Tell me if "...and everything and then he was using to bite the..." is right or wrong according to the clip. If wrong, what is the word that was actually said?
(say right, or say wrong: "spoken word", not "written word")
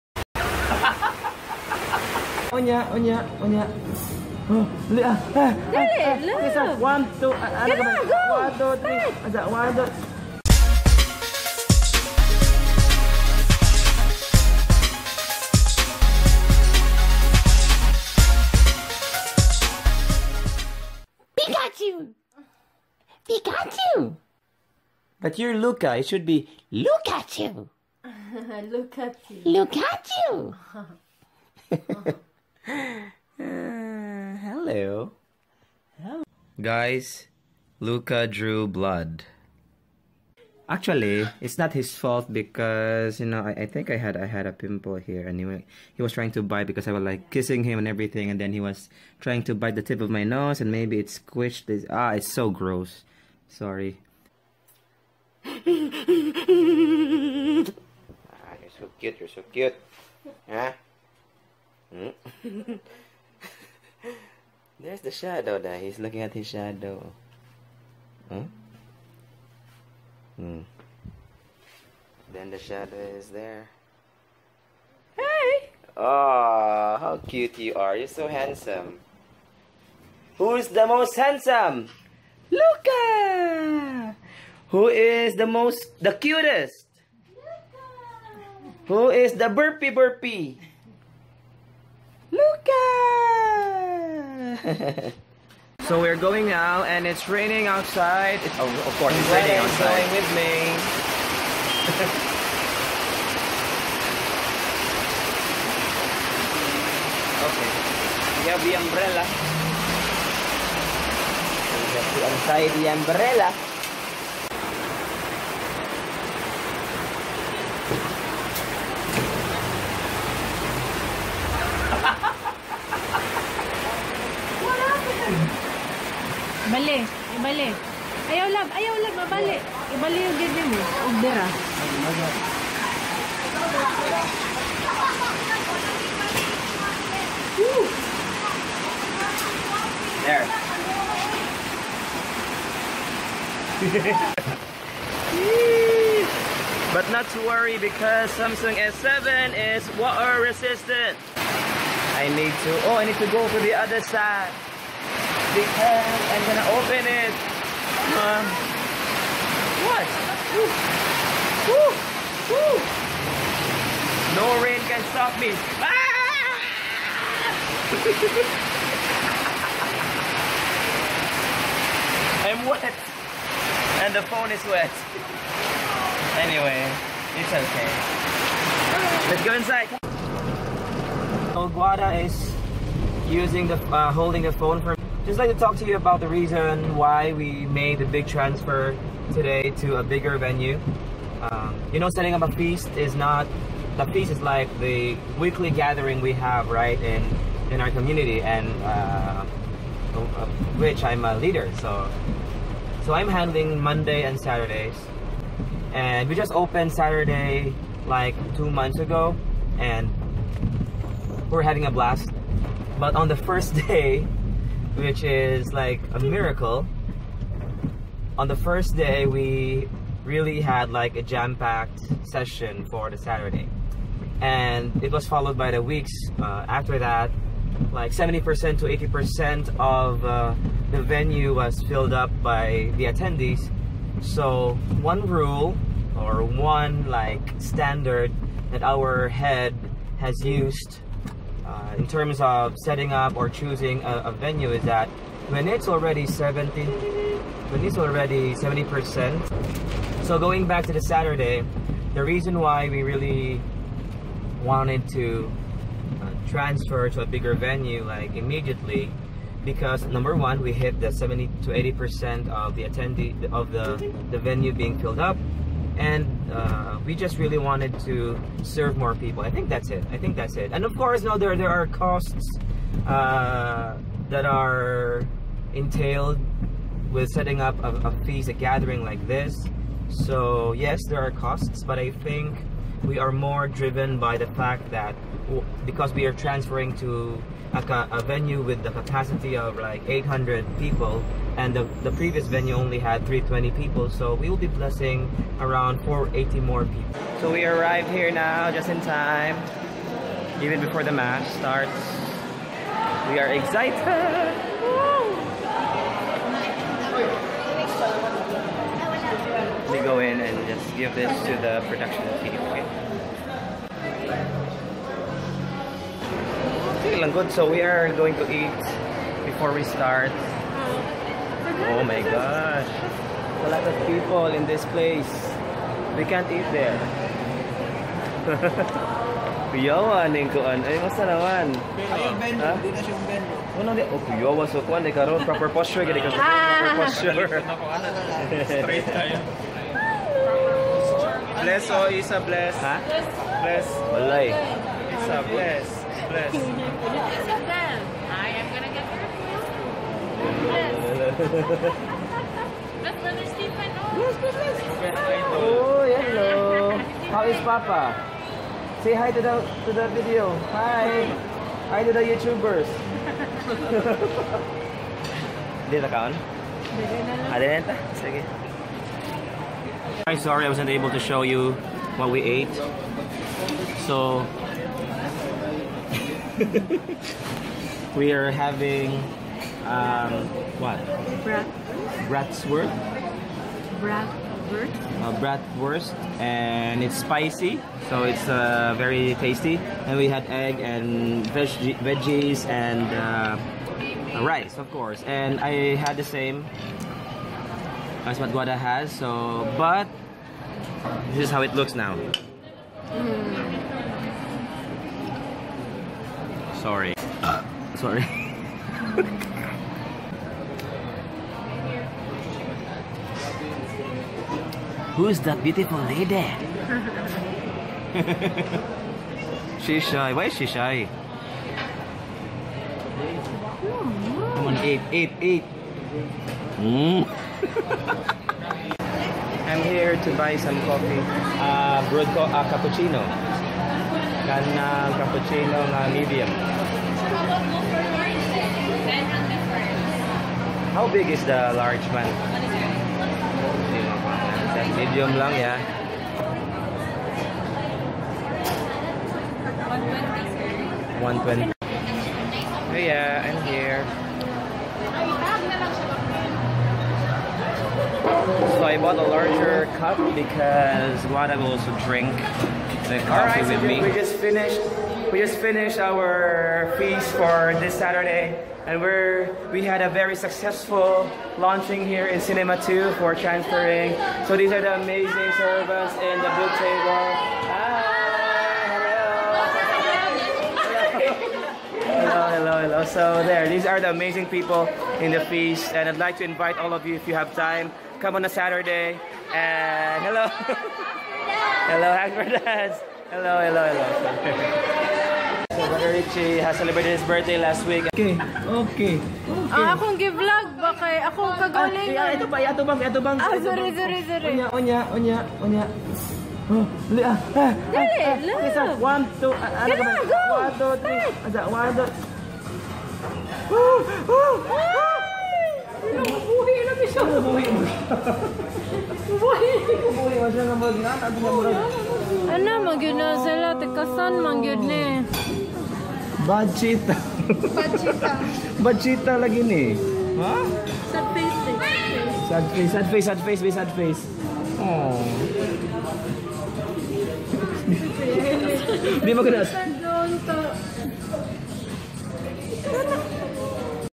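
wrong: "trying", not "using".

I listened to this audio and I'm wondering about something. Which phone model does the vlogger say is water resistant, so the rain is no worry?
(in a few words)
Samsung S7.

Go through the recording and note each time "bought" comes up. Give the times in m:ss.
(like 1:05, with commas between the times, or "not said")
7:38.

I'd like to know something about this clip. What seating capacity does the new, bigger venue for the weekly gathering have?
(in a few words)
800.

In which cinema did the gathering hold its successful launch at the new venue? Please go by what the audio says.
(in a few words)
Cinema 2.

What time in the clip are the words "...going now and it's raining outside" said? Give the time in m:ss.
1:36.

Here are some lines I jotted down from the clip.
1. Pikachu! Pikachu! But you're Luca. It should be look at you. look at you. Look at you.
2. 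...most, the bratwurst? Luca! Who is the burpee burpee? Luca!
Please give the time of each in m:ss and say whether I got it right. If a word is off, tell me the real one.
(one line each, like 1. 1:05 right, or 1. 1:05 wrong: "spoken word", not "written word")
1. 0:21 right
2. 1:25 wrong: "cutest", not "bratwurst".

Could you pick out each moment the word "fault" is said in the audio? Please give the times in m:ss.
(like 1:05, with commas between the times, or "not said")
0:41.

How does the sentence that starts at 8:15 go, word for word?
so Brother Richie has celebrated his birthday last week.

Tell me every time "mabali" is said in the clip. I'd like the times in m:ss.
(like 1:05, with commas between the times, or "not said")
2:09.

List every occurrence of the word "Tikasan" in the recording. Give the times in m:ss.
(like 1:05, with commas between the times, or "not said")
8:43.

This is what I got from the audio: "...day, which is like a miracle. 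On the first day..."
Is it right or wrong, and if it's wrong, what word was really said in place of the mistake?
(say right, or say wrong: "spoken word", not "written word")
right.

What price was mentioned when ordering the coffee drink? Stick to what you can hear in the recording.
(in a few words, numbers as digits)
120.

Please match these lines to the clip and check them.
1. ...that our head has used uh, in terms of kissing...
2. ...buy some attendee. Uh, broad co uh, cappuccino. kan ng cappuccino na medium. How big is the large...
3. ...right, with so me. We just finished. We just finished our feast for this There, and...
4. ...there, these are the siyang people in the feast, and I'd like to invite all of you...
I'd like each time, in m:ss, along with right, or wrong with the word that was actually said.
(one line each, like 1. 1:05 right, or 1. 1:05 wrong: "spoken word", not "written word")
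1. 3:58 wrong: "setting", not "kissing"
2. 7:10 wrong: "coffee", not "attendee"
3. 7:43 wrong: "Saturday", not "There"
4. 8:03 wrong: "amazing", not "siyang".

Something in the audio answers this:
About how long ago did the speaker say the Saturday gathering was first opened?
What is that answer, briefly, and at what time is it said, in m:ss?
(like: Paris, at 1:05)
two months ago, at 3:28.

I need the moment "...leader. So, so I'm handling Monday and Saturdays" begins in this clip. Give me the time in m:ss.
3:21.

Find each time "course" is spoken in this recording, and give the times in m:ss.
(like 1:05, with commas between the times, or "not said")
1:38, 4:30, 6:34.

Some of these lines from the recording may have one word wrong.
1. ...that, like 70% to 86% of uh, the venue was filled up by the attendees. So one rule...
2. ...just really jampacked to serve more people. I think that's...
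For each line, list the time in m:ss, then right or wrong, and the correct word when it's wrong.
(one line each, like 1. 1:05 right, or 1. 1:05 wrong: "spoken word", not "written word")
1. 3:46 wrong: "80", not "86"
2. 4:27 wrong: "wanted", not "jampacked".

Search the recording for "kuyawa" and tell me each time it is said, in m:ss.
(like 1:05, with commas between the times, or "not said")
5:29, 5:34.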